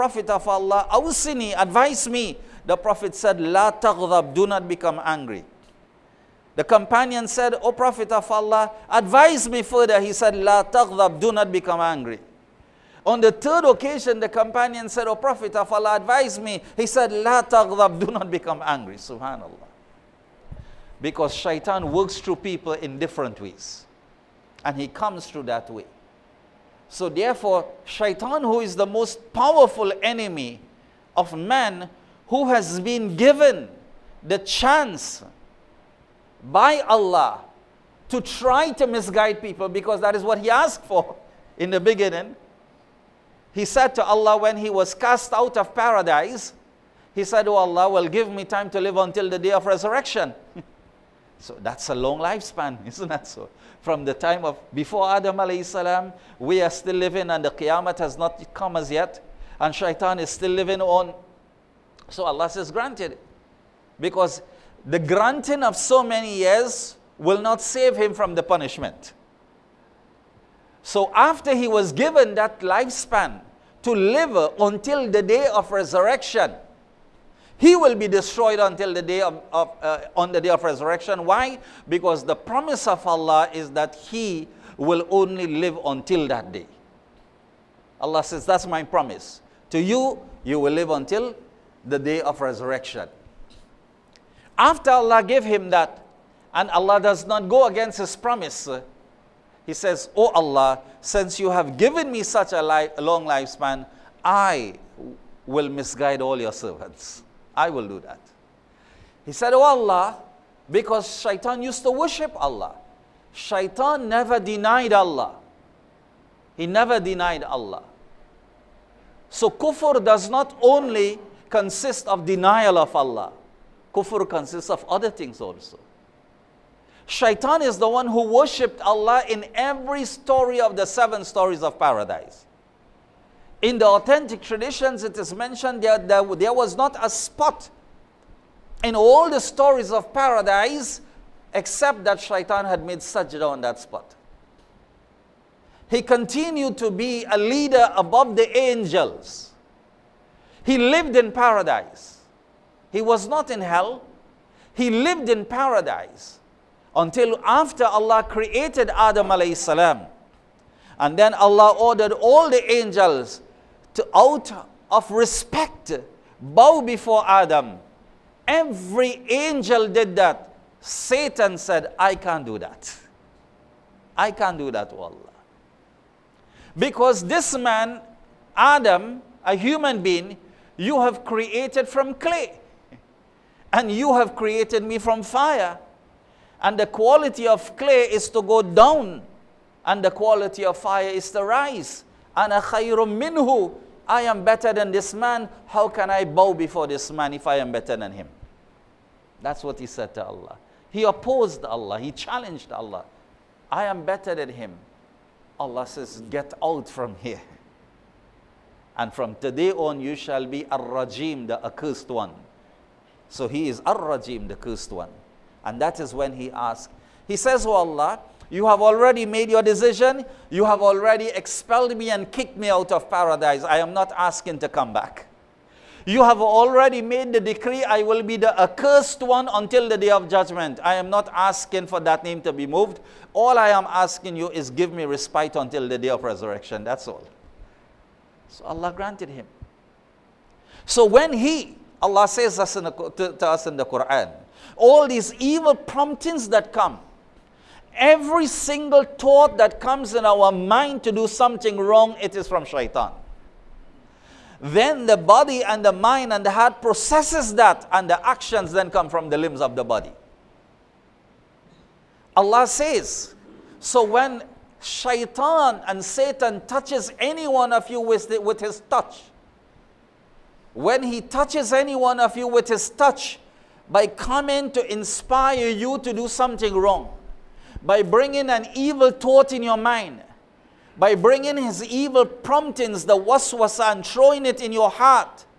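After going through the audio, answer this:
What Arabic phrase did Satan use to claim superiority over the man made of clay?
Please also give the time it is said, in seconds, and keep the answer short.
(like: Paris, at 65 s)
Ana khayrum minhu, at 192 s.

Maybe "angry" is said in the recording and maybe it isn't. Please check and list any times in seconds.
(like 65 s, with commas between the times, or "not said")
5 s, 11 s, 18 s.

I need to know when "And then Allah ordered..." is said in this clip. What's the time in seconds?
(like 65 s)
160 s.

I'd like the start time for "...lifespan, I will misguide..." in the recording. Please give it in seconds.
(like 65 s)
103 s.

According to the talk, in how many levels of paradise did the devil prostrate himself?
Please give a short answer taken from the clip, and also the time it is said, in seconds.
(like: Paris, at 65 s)
7, at 130 s.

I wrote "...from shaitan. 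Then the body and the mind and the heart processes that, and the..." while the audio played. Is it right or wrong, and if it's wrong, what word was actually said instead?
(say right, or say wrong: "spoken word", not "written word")
right.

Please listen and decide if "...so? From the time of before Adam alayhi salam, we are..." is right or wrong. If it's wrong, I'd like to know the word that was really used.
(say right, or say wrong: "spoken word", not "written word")
right.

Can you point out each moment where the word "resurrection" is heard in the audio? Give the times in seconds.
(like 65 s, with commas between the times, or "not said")
49 s, 75 s, 80 s, 92 s, 236 s.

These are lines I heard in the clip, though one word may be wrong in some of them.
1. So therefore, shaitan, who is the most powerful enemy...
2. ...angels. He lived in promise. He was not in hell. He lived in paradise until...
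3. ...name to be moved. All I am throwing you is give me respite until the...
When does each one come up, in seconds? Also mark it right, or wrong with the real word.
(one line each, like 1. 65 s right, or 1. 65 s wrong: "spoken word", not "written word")
1. 26 s right
2. 148 s wrong: "paradise", not "promise"
3. 232 s wrong: "asking", not "throwing".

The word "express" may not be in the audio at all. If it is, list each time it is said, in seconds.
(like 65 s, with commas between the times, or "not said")
not said.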